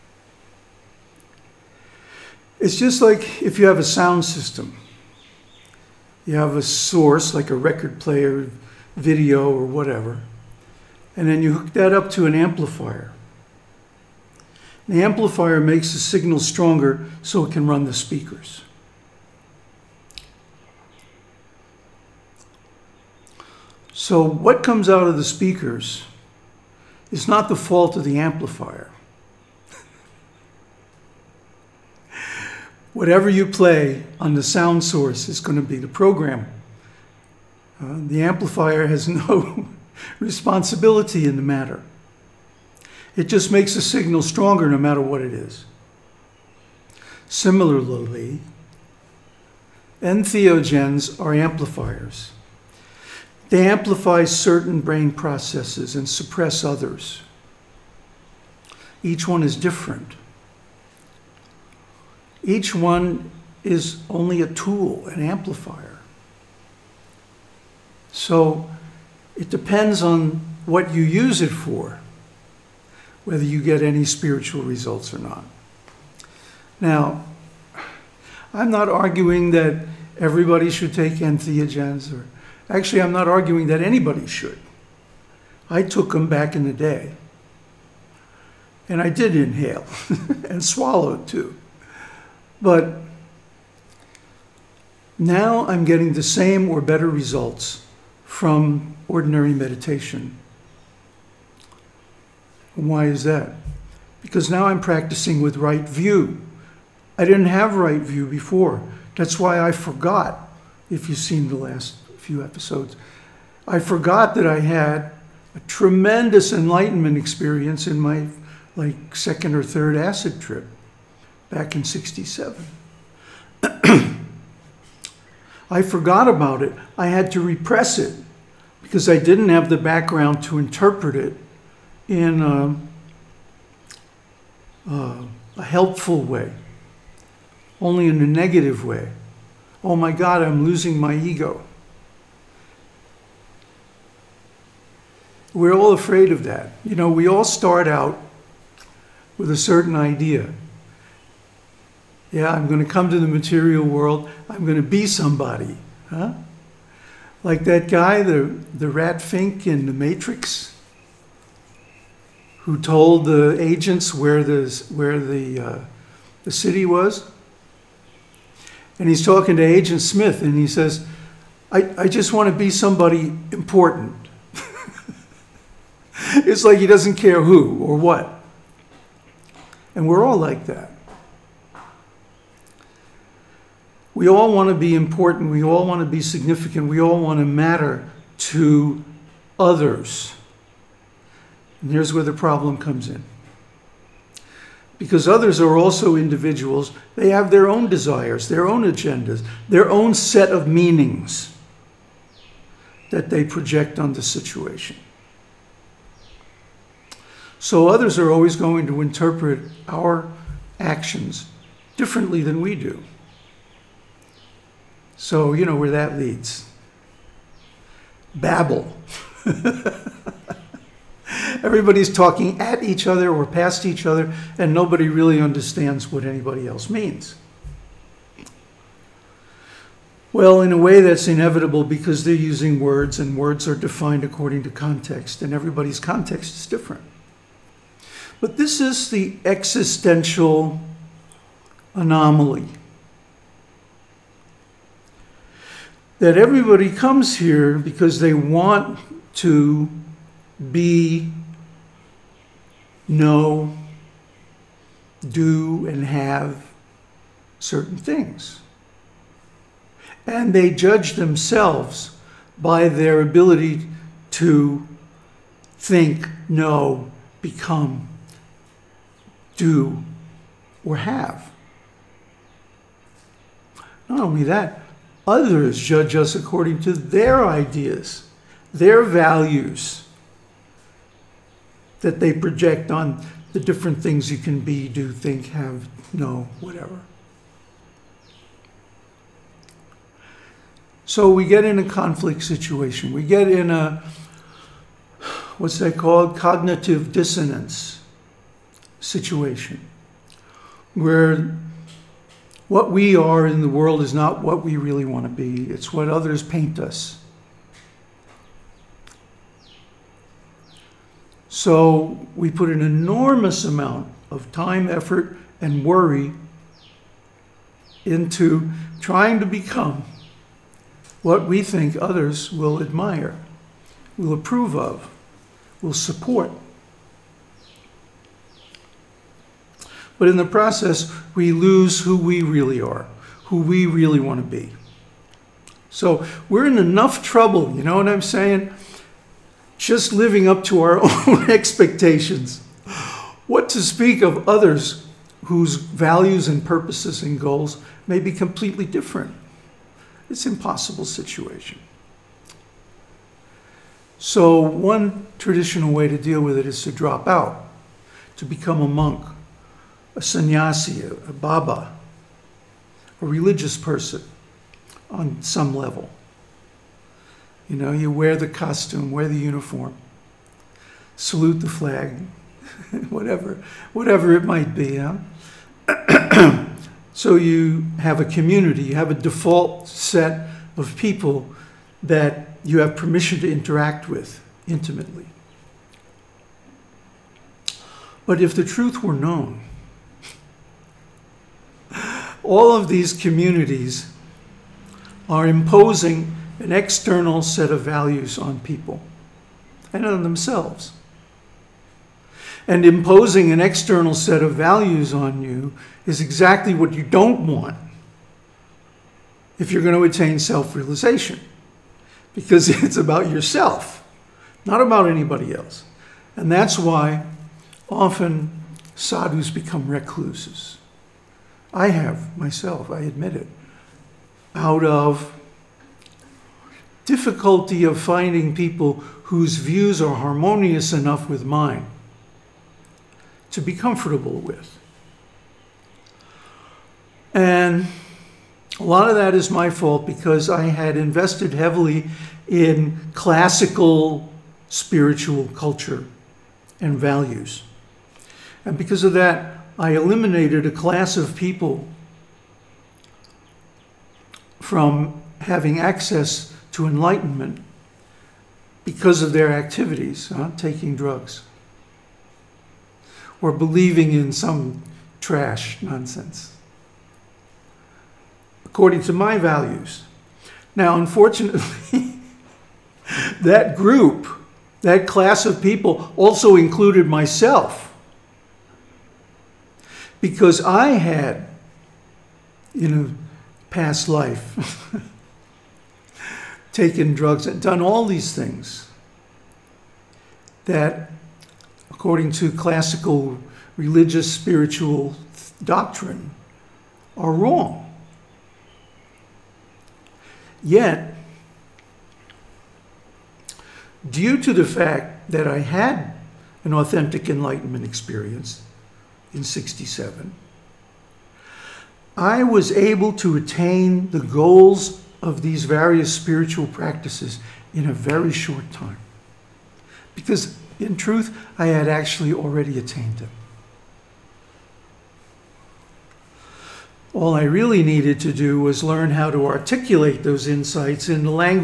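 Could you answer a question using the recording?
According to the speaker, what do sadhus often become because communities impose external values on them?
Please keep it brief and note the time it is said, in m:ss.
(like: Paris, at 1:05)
recluses, at 6:59.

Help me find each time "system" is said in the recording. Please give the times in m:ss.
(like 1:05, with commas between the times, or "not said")
0:04.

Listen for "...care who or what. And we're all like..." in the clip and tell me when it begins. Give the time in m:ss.
2:57.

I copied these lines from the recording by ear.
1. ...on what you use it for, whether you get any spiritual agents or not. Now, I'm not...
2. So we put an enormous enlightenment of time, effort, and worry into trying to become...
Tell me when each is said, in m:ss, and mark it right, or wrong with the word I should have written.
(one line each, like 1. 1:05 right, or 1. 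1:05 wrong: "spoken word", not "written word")
1. 1:10 wrong: "results", not "agents"
2. 5:11 wrong: "amount", not "enlightenment".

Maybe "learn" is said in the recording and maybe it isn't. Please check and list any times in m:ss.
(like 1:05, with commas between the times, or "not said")
8:48.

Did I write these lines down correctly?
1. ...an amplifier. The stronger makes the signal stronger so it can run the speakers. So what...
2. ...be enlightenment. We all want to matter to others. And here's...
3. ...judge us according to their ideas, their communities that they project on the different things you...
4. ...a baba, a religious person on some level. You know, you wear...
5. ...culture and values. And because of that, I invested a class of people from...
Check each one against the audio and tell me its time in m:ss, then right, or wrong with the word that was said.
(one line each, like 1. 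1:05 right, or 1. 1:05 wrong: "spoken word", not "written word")
1. 0:12 wrong: "amplifier", not "stronger"
2. 3:06 wrong: "significant", not "enlightenment"
3. 4:35 wrong: "values", not "communities"
4. 6:01 right
5. 7:25 wrong: "eliminated", not "invested".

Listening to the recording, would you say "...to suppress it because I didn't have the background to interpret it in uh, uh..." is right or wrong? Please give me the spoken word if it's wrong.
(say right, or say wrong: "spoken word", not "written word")
wrong: "repress", not "suppress".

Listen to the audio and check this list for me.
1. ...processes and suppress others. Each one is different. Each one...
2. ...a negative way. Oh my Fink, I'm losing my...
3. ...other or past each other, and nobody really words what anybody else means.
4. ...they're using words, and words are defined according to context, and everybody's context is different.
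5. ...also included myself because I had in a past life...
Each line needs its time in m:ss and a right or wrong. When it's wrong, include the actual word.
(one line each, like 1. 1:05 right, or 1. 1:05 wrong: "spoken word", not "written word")
1. 0:55 right
2. 2:18 wrong: "God", not "Fink"
3. 3:43 wrong: "understands", not "words"
4. 3:52 right
5. 7:56 right.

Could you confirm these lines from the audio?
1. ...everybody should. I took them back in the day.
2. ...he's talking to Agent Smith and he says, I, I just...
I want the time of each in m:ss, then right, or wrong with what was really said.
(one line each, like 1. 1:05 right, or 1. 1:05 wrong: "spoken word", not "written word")
1. 1:23 wrong: "anybody", not "everybody"
2. 2:49 right.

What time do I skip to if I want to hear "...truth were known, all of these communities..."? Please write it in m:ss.
6:28.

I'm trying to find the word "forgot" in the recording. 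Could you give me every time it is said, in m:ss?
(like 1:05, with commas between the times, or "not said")
1:49, 1:53, 2:05.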